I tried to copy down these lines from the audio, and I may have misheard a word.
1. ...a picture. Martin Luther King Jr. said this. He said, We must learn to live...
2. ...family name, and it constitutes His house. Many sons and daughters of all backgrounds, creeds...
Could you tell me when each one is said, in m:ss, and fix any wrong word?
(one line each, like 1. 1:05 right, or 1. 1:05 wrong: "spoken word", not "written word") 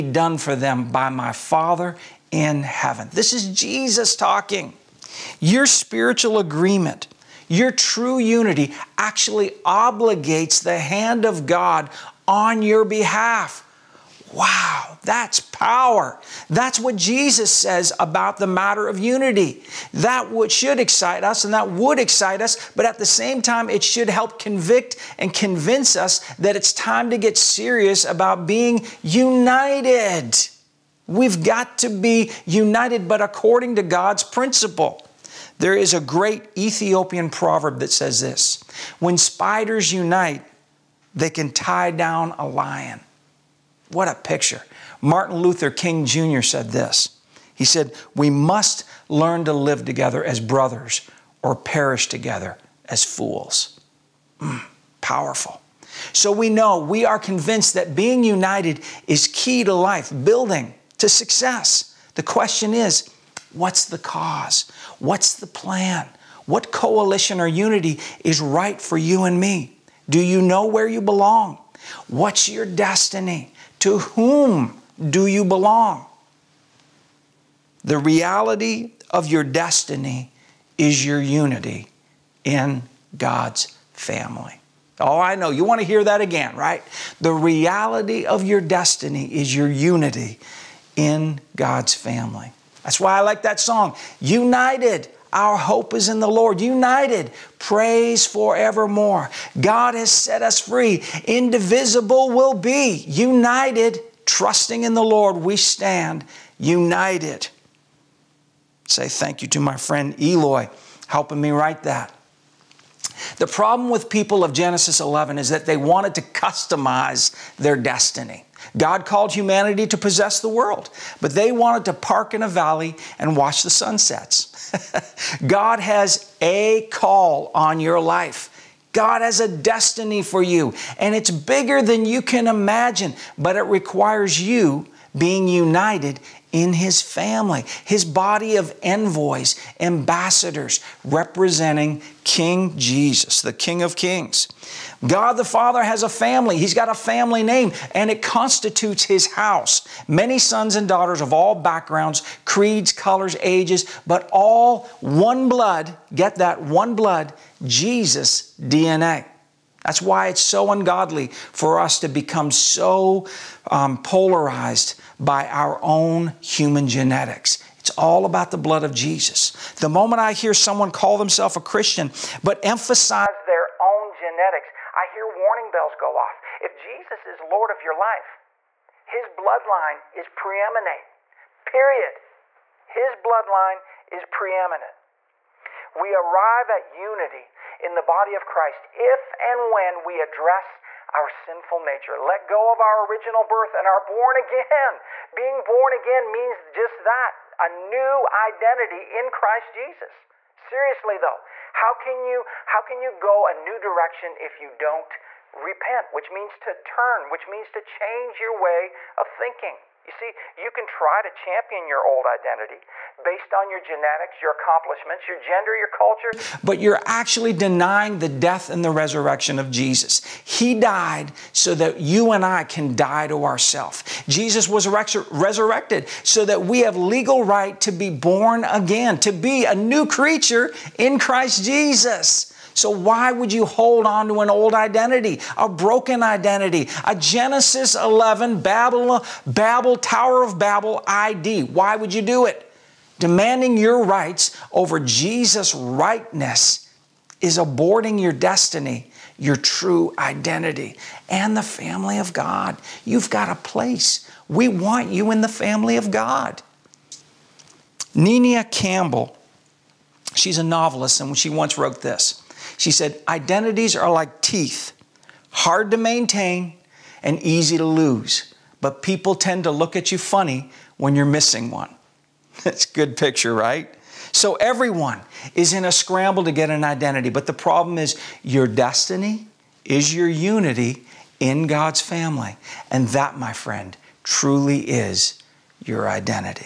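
1. 0:44 right
2. 2:26 right.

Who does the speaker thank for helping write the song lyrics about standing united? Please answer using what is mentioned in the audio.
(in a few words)
Eloy.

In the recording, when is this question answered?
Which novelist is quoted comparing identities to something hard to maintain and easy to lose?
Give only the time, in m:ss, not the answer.
4:18.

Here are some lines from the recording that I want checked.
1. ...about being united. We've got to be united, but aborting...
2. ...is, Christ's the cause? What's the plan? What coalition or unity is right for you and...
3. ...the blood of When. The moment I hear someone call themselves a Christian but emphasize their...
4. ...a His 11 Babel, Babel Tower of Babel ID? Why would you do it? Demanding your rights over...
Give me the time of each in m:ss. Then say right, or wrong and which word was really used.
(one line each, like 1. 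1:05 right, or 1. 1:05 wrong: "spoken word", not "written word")
1. 0:28 wrong: "according", not "aborting"
2. 1:02 wrong: "What", not "Christ"
3. 2:48 wrong: "Jesus", not "When"
4. 3:57 wrong: "Genesis", not "His".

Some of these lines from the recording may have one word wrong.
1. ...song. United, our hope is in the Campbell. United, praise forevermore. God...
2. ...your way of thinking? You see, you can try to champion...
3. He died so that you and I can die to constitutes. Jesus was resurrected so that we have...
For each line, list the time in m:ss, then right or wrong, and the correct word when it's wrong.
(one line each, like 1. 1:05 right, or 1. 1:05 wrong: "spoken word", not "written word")
1. 1:33 wrong: "Lord", not "Campbell"
2. 3:28 right
3. 3:40 wrong: "ourselves", not "constitutes".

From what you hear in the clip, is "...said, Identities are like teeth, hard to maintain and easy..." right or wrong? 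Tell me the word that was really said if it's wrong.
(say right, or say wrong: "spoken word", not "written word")
right.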